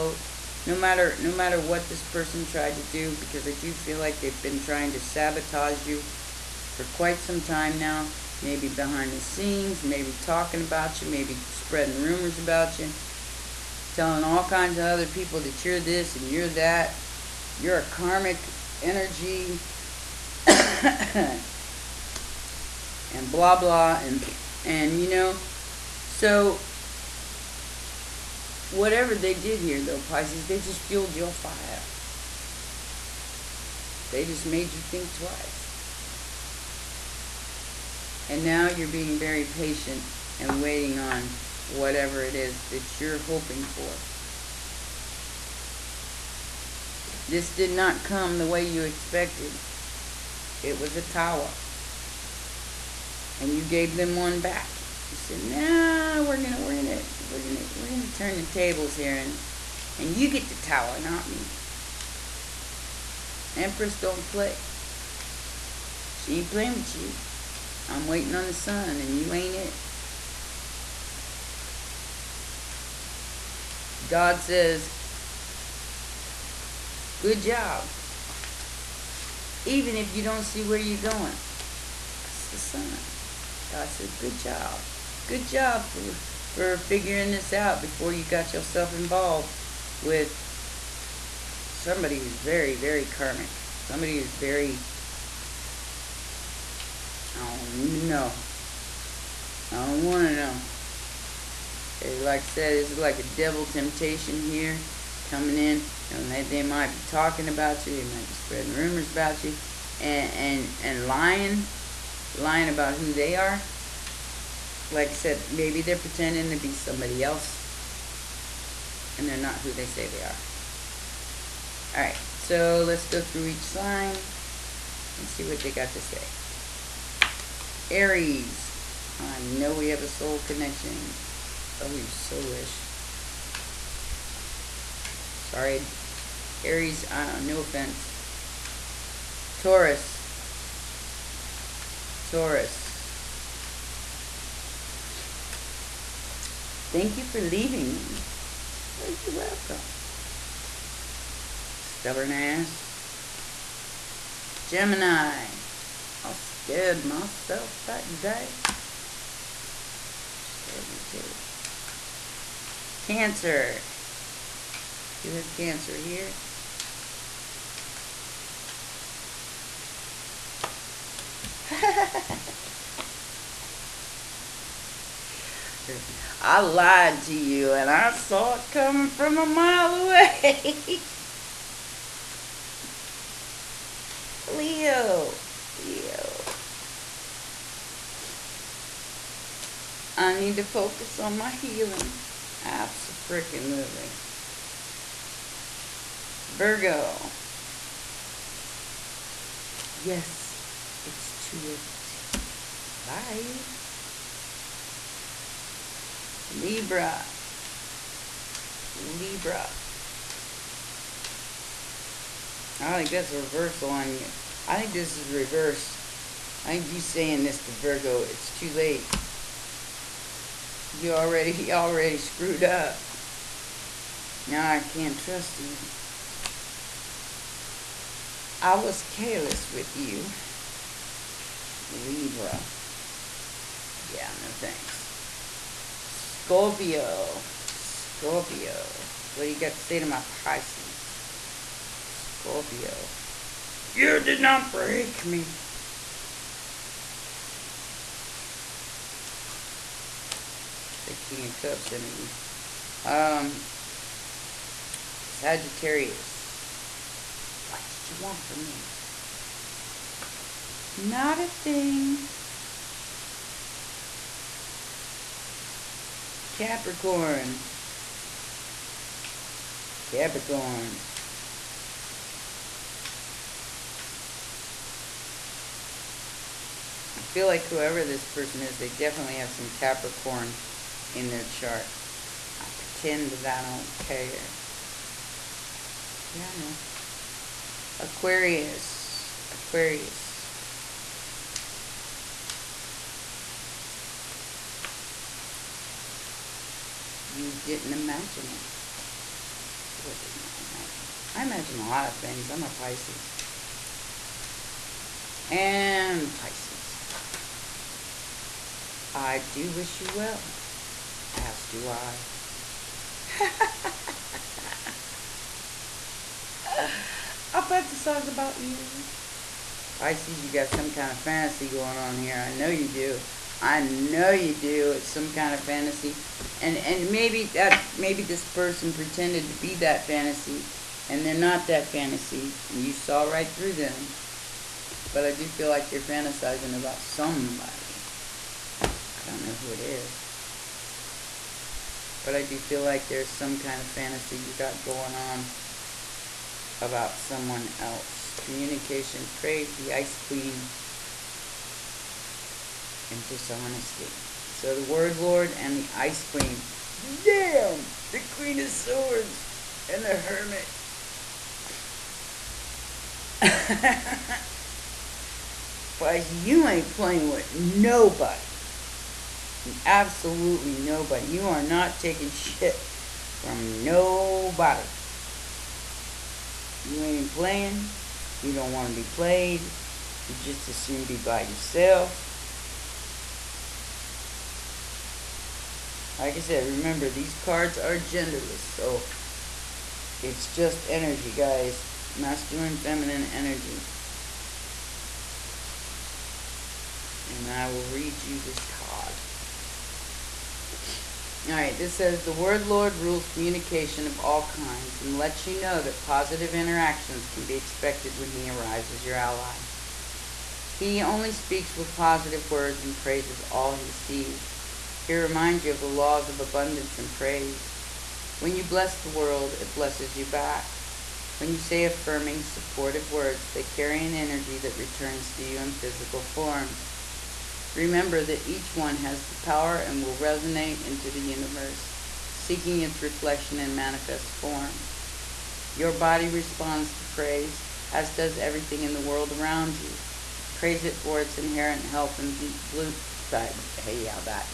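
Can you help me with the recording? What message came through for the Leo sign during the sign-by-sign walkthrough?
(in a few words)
I need to focus on my healing.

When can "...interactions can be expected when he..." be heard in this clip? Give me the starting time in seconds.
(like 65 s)
406 s.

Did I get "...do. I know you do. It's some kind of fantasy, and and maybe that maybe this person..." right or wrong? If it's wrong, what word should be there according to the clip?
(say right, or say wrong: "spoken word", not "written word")
right.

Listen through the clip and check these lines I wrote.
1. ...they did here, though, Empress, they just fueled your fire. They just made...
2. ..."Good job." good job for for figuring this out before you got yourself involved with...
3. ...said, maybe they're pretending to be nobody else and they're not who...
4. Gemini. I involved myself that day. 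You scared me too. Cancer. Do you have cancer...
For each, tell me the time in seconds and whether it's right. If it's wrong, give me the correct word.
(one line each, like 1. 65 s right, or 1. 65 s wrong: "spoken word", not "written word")
1. 29 s wrong: "Pisces", not "Empress"
2. 84 s right
3. 115 s wrong: "somebody", not "nobody"
4. 154 s wrong: "scared", not "involved".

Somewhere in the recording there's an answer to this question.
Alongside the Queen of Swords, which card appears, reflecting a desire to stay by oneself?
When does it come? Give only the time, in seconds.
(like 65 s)
360 s.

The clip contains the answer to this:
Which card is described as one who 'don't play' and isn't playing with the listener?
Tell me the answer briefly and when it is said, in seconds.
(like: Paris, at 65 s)
Empress, at 63 s.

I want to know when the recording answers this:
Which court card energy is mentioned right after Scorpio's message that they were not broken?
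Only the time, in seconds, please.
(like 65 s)
251 s.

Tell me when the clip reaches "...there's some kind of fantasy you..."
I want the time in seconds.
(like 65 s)
343 s.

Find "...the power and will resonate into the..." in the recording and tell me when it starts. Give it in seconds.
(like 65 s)
429 s.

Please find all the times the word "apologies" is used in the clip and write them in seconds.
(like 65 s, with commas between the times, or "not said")
not said.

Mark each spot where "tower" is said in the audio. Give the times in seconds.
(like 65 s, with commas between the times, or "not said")
51 s, 60 s.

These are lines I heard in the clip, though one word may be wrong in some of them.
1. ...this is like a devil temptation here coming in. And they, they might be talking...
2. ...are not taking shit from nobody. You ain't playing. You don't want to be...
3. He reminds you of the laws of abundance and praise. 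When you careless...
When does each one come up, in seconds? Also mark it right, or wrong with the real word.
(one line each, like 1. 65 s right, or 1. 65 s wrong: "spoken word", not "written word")
1. 102 s right
2. 371 s right
3. 415 s wrong: "bless", not "careless".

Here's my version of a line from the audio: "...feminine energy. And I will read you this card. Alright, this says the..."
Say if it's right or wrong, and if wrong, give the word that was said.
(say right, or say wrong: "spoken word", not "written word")
right.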